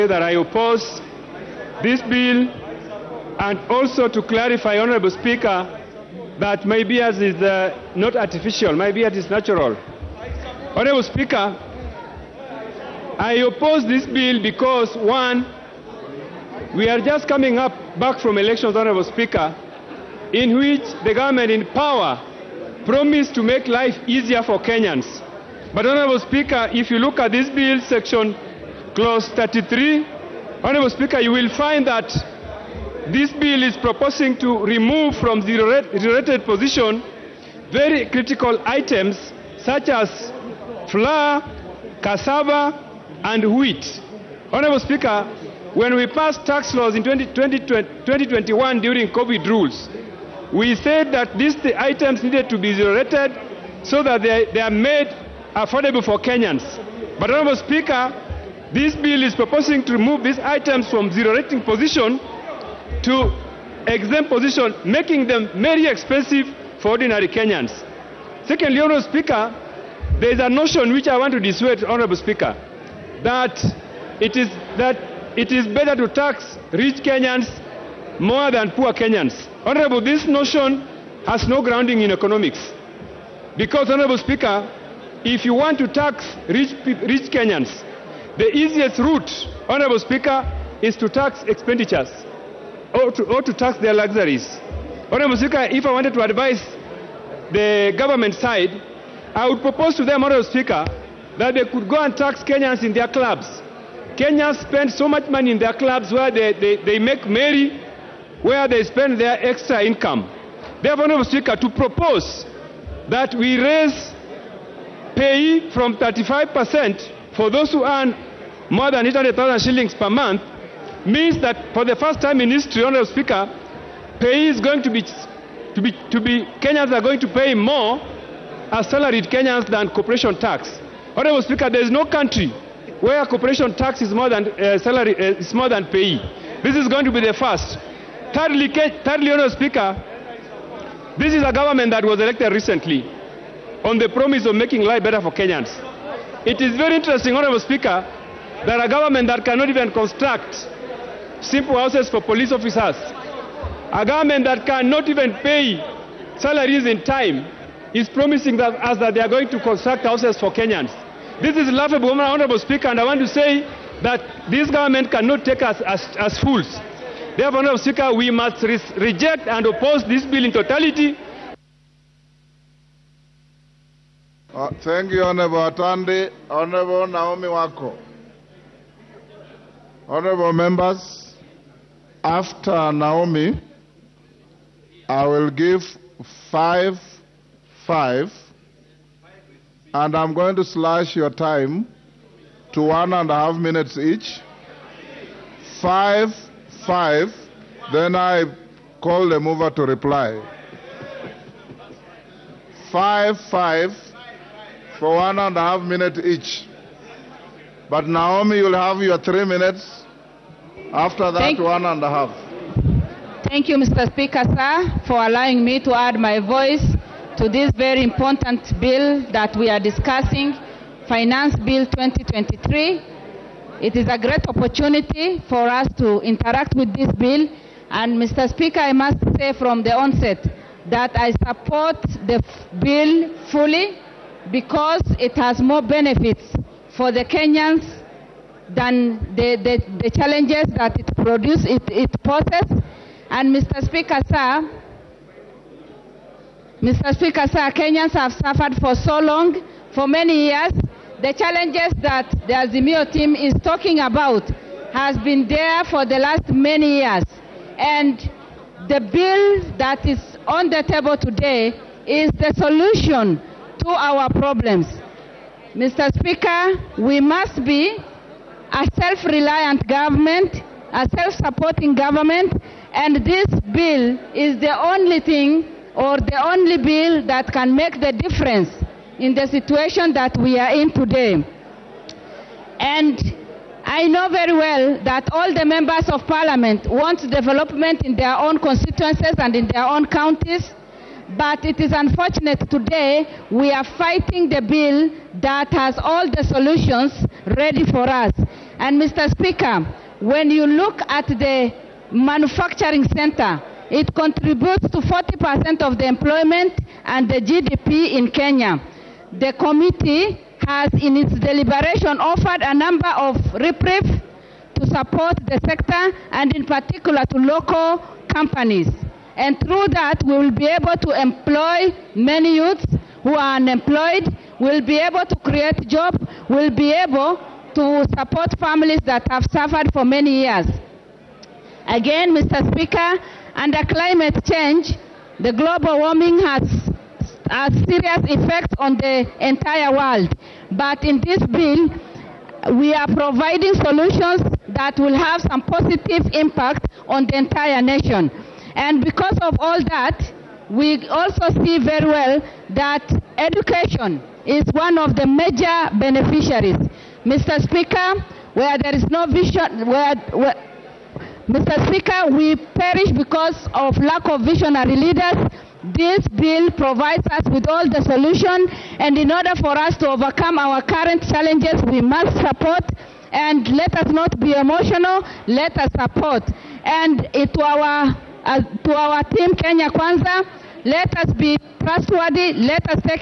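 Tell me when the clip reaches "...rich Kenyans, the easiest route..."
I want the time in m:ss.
1:26.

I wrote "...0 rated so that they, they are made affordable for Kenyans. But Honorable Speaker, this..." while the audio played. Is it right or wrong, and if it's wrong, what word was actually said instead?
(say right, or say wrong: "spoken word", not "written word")
right.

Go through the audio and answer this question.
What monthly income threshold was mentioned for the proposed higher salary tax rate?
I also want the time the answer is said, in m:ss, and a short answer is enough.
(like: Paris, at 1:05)
800,000 shillings, at 1:59.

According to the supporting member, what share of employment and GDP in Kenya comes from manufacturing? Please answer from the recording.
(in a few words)
40%.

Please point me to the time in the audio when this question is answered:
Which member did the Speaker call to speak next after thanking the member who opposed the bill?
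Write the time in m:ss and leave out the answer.
2:57.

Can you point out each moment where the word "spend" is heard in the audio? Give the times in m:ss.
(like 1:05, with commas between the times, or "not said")
1:44, 1:48.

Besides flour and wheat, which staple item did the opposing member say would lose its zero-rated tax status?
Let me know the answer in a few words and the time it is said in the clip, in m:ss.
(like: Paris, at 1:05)
Cassava, at 0:42.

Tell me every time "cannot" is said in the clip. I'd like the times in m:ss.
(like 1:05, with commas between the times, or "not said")
2:29, 2:34, 2:45.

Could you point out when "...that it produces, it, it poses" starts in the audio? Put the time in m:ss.
4:00.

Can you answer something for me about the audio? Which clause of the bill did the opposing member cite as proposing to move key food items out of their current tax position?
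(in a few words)
Clause 33.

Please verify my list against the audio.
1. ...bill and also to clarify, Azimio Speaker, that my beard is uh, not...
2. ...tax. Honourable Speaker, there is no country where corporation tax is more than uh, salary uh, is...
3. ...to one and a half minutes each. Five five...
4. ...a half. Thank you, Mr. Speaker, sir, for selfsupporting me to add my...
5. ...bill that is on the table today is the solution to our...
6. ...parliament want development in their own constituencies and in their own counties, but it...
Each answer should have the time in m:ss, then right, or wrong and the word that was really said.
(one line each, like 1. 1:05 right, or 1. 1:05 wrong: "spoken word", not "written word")
1. 0:02 wrong: "Honorable", not "Azimio"
2. 2:10 right
3. 3:12 right
4. 3:32 wrong: "allowing", not "selfsupporting"
5. 4:19 right
6. 4:46 right.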